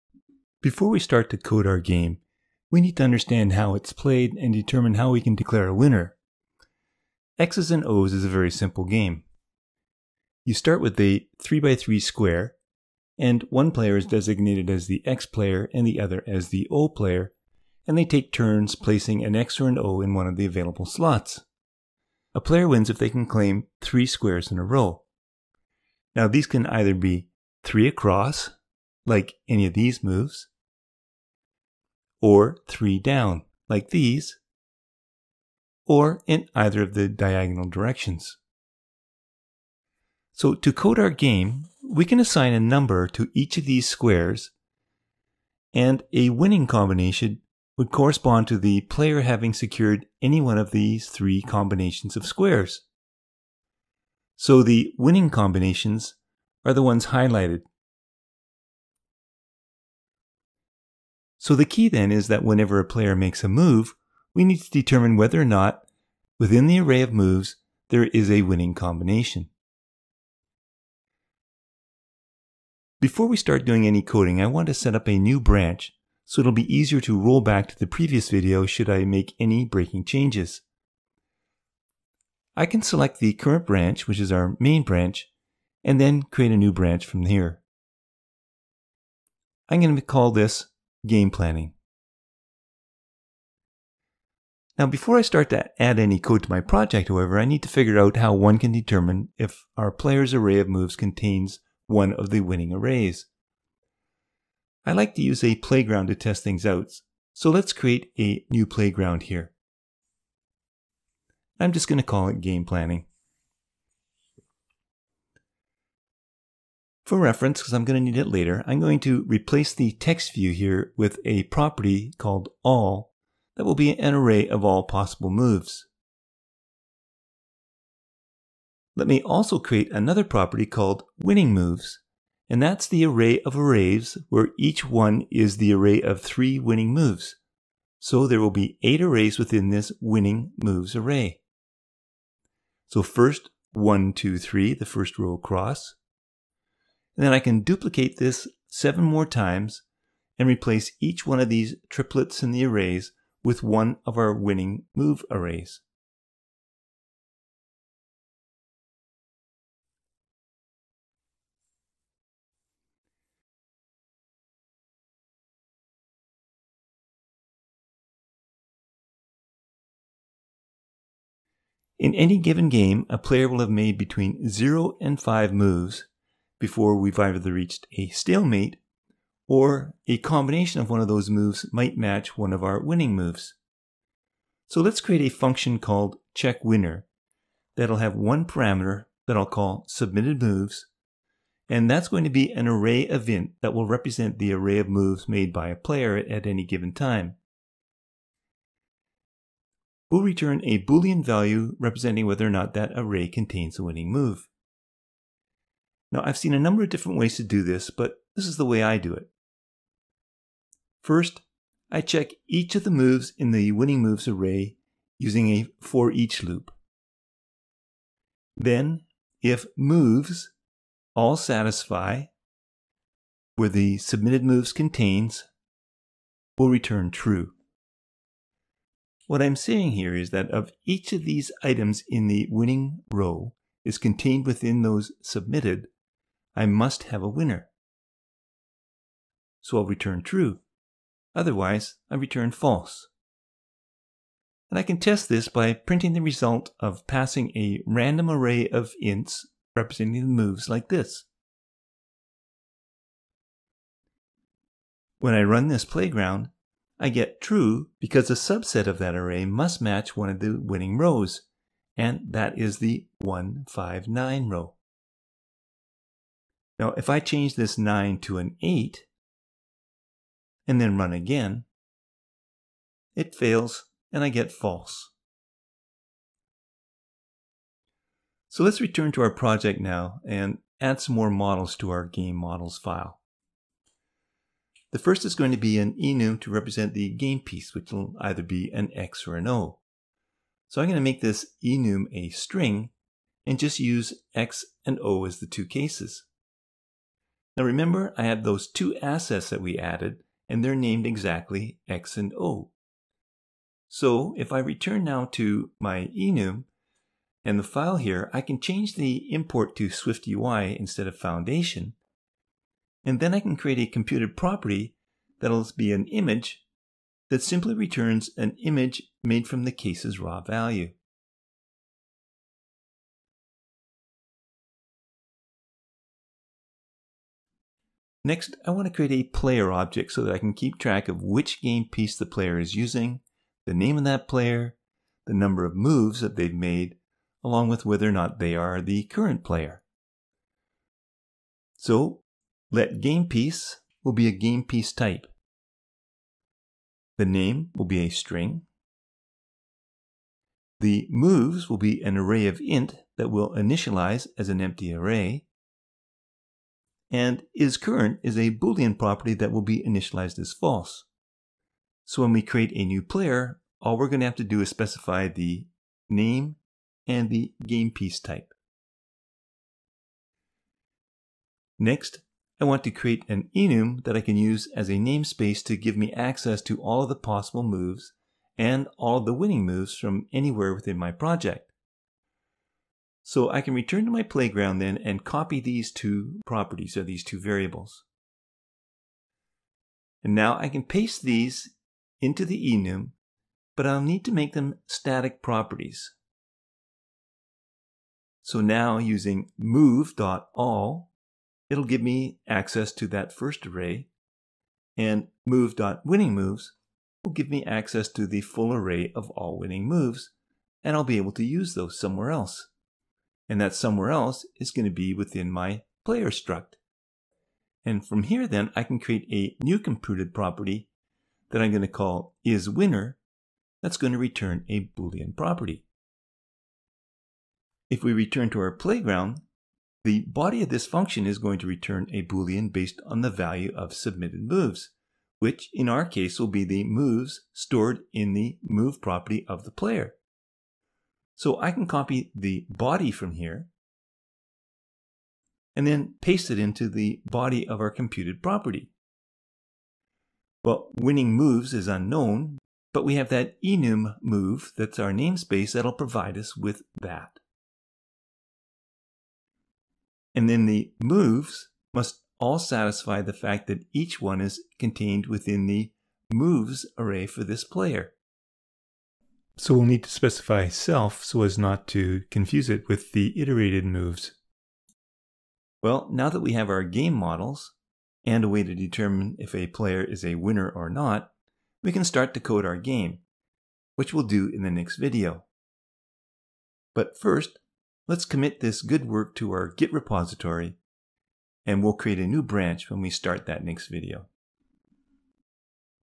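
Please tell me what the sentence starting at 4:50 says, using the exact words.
So I'm going to make this enum a string and just use X and O as the two cases.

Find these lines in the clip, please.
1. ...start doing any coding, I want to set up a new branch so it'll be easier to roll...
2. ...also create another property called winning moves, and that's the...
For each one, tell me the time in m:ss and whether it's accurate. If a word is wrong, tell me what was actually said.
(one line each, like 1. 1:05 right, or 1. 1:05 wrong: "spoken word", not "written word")
1. 1:13 right
2. 2:09 right.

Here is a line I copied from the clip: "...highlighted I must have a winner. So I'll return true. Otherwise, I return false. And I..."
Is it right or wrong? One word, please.
wrong.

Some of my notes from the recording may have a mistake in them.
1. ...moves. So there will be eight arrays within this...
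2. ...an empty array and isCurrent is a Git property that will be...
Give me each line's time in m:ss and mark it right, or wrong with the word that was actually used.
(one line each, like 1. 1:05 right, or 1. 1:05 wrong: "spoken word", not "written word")
1. 2:16 right
2. 5:54 wrong: "Boolean", not "Git".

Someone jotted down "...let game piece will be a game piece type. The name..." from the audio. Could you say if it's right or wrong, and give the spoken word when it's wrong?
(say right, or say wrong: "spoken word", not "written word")
right.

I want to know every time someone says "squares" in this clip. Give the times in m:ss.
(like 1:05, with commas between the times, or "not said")
0:11, 0:24, 0:43, 0:52.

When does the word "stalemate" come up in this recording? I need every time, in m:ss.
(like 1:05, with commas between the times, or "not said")
2:58.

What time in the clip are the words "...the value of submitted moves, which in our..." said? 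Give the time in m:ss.
7:13.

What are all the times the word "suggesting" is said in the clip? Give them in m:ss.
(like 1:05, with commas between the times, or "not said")
not said.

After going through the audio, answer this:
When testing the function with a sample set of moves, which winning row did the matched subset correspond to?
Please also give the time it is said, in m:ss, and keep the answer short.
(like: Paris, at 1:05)
159, at 4:23.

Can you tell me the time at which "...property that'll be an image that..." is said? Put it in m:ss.
5:14.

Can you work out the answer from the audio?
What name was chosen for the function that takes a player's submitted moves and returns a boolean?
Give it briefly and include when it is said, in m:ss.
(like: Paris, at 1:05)
checkWinner, at 3:06.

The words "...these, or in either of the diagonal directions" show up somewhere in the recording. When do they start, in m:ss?
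0:33.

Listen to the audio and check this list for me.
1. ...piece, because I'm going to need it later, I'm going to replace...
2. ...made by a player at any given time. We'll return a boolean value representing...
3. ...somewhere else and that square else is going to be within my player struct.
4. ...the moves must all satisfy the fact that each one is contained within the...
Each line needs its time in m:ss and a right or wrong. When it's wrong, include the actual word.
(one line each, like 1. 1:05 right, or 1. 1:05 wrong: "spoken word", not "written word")
1. 1:57 wrong: "reference", not "piece"
2. 3:15 right
3. 6:51 wrong: "somewhere", not "square"
4. 7:40 right.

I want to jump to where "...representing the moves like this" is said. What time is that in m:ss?
4:09.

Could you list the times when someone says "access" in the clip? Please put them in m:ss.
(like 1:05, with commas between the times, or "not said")
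6:16, 6:42, 6:47.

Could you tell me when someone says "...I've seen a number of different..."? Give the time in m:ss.
3:26.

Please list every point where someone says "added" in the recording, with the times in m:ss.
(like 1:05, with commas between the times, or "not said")
4:59.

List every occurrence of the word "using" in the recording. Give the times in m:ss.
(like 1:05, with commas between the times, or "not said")
3:35, 5:32, 6:38.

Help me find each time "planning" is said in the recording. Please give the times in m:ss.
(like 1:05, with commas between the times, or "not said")
1:31, 1:52.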